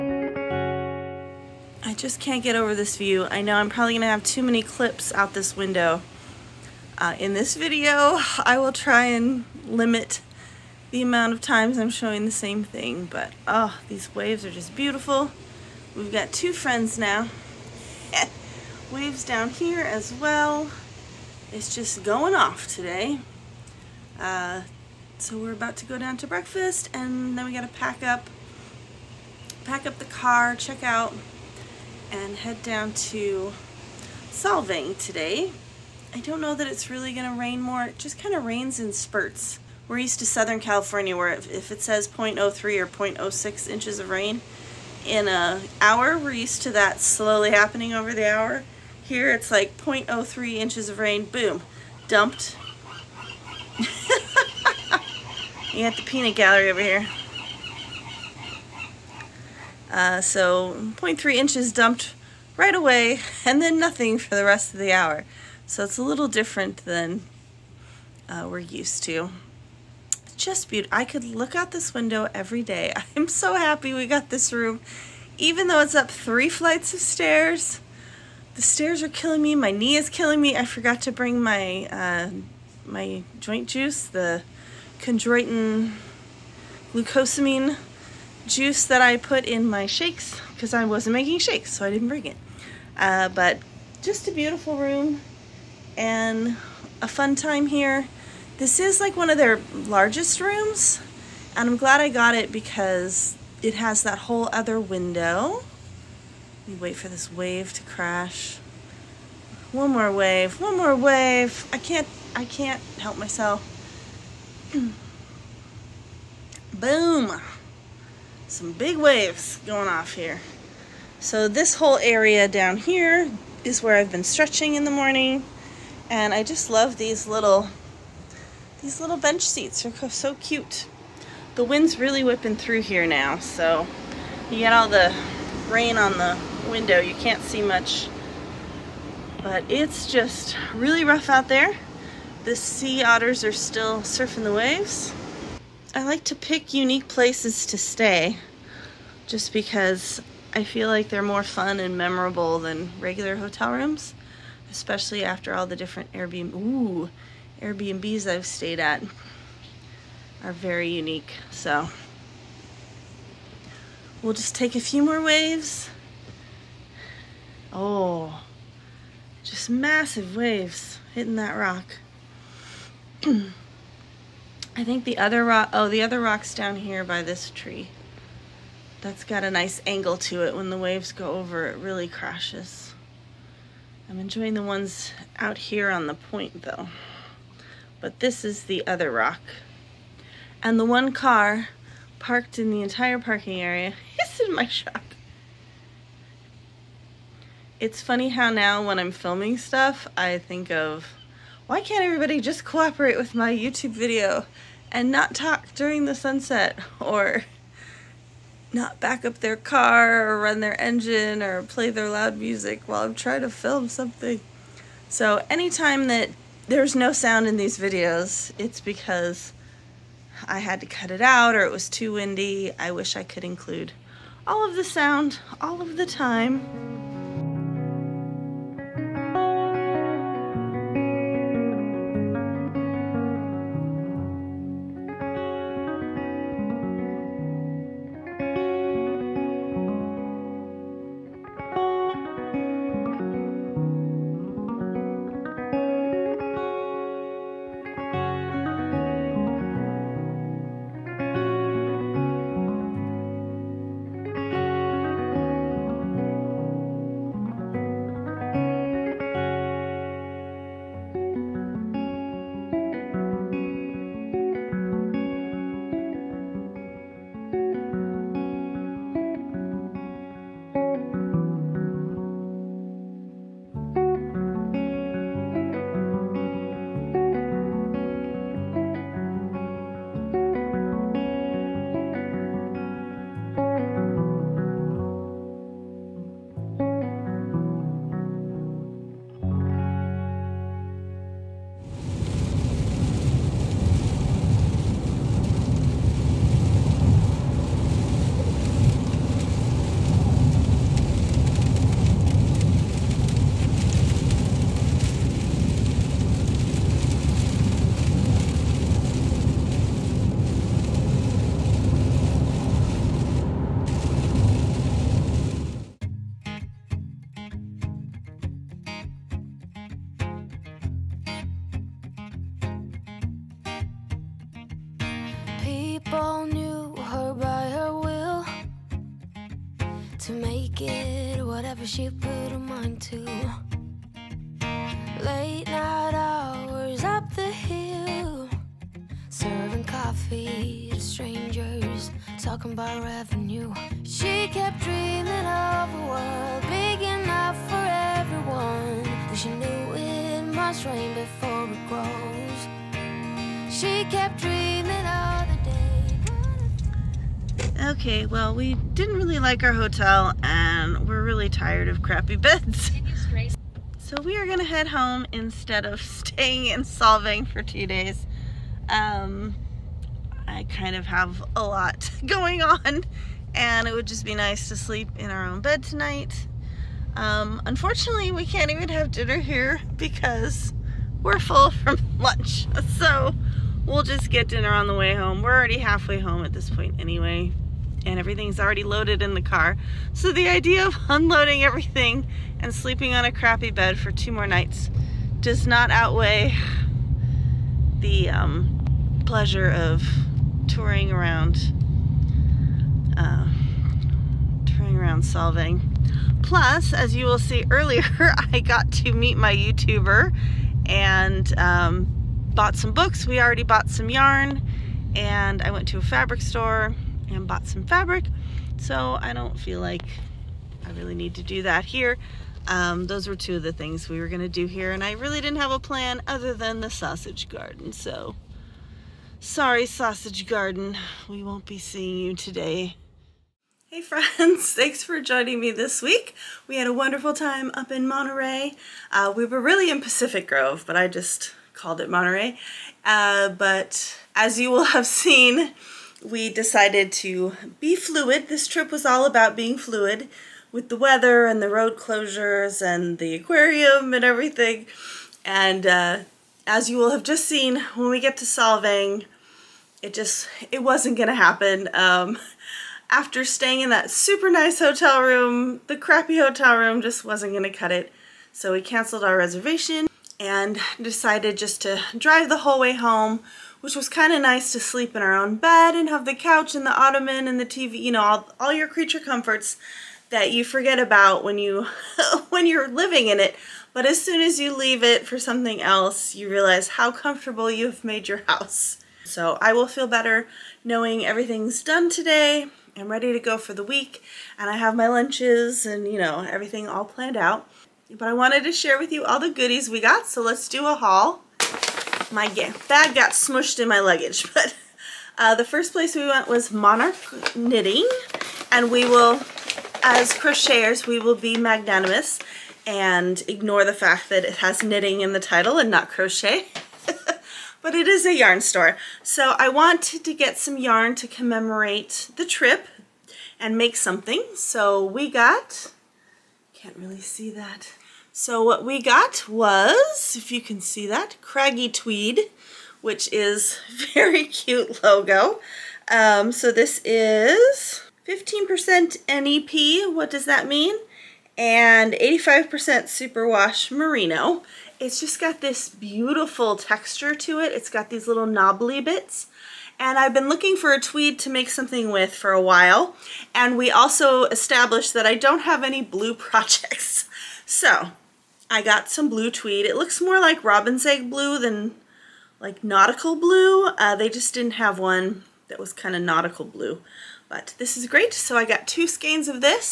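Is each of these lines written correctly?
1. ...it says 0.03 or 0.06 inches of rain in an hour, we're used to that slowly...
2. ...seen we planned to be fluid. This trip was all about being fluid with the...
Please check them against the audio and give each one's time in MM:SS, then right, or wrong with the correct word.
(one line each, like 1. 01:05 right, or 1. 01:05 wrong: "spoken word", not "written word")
1. 00:41 right
2. 07:25 wrong: "decided", not "planned".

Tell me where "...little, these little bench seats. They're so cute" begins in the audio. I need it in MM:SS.
02:07.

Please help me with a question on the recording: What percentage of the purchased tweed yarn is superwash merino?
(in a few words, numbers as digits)
85%.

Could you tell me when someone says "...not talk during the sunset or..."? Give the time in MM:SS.
03:25.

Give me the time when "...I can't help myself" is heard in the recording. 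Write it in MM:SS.
01:52.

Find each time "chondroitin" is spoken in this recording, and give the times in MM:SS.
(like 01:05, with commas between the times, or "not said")
01:24.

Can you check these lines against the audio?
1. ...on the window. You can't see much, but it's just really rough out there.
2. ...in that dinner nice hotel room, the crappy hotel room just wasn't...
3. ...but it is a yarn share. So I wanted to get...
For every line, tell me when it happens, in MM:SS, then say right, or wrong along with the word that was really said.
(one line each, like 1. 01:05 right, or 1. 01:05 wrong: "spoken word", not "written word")
1. 02:15 right
2. 07:43 wrong: "super", not "dinner"
3. 08:37 wrong: "store", not "share".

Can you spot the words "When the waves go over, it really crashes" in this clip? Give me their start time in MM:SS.
03:00.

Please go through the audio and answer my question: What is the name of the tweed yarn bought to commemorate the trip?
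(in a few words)
Craggy Tweed.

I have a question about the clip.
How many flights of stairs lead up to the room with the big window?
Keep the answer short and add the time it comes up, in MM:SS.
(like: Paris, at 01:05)
3, at 01:16.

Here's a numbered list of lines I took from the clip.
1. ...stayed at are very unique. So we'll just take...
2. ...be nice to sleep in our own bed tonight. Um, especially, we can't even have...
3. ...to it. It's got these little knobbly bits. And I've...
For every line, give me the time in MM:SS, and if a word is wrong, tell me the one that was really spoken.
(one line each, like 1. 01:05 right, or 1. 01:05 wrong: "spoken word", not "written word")
1. 02:38 right
2. 06:14 wrong: "unfortunately", not "especially"
3. 09:07 right.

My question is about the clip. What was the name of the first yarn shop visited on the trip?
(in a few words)
Monarch Knitting.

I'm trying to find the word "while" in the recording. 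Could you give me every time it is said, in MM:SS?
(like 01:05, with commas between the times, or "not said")
03:32, 09:12.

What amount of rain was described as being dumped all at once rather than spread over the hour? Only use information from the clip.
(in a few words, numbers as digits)
0.3 inches.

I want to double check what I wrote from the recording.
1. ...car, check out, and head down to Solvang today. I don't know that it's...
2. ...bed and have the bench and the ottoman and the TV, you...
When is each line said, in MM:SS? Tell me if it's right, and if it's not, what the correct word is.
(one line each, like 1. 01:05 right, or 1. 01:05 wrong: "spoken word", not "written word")
1. 00:30 right
2. 07:55 wrong: "couch", not "bench".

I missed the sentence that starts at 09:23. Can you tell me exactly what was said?
Uh, they just didn't have one that was kind of nautical blue.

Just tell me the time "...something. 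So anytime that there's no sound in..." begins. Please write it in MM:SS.
03:33.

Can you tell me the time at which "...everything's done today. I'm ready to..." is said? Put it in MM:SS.
08:11.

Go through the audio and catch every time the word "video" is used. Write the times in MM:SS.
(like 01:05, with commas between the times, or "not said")
00:07, 03:23, 03:37.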